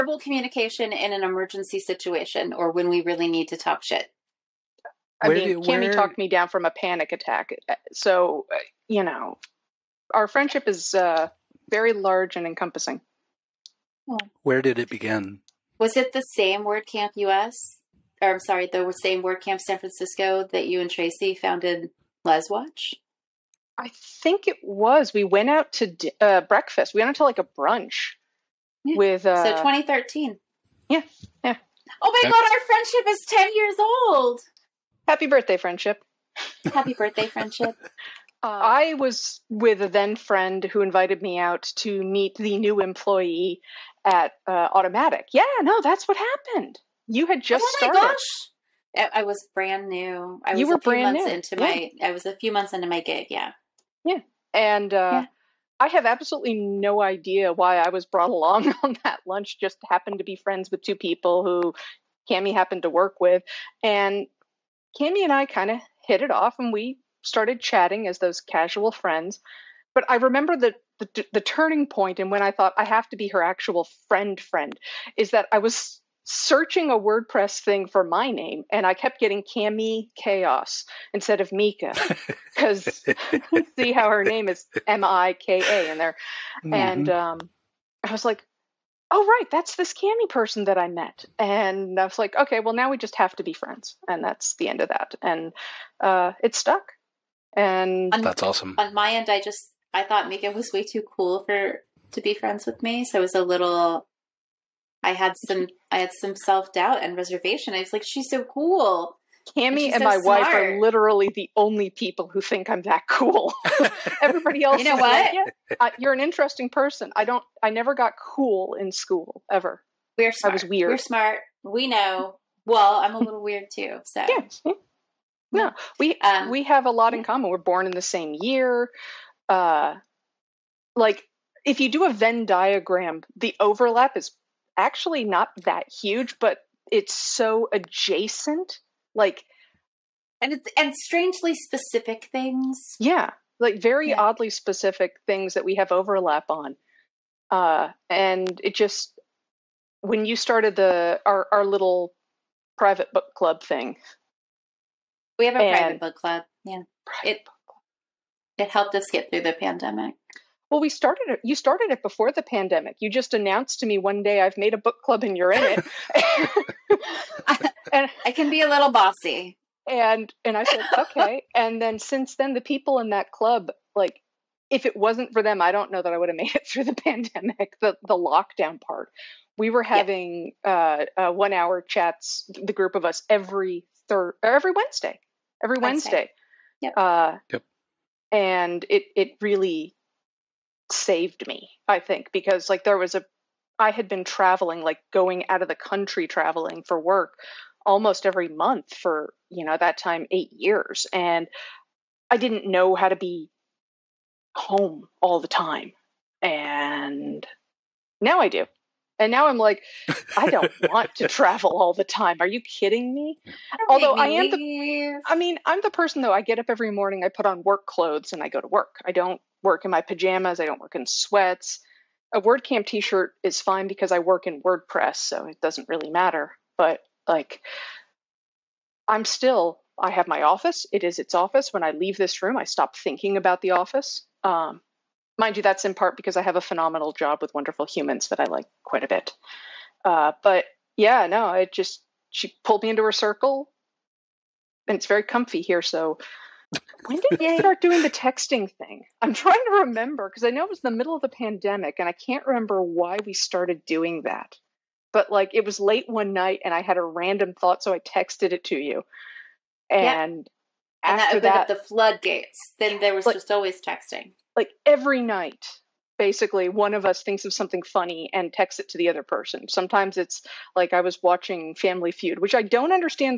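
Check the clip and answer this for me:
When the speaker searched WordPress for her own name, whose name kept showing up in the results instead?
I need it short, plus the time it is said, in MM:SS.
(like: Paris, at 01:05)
Cami Kaos, at 01:19.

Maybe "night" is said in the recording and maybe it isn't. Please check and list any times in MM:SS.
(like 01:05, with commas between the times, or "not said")
04:16, 04:25.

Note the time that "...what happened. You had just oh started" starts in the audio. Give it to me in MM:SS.
00:46.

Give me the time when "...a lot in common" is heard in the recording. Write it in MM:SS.
02:06.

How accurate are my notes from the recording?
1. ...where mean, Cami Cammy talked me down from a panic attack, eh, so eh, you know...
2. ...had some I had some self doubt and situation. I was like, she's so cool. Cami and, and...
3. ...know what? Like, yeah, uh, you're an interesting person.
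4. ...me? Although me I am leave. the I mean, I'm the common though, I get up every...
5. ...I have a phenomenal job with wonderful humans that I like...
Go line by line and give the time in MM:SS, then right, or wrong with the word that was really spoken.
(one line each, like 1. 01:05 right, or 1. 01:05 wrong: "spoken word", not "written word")
1. 00:05 right
2. 01:45 wrong: "reservation", not "situation"
3. 01:54 right
4. 03:33 wrong: "person", not "common"
5. 03:56 right.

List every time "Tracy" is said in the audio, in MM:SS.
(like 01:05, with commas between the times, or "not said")
00:20.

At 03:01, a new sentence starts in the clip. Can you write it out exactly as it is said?
uh, uh, one hour chats the group of us every third every wednesday every wednesday, wednesday.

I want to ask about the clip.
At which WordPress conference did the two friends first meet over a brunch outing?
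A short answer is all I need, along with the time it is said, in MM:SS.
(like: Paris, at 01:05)
WordCamp San Francisco, at 00:19.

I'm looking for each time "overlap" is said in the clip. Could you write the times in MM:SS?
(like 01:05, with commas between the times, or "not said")
02:13, 02:25.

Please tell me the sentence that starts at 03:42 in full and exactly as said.
A WordCamp t-shirt is fine because I work in WordPress, so it doesn't really matter.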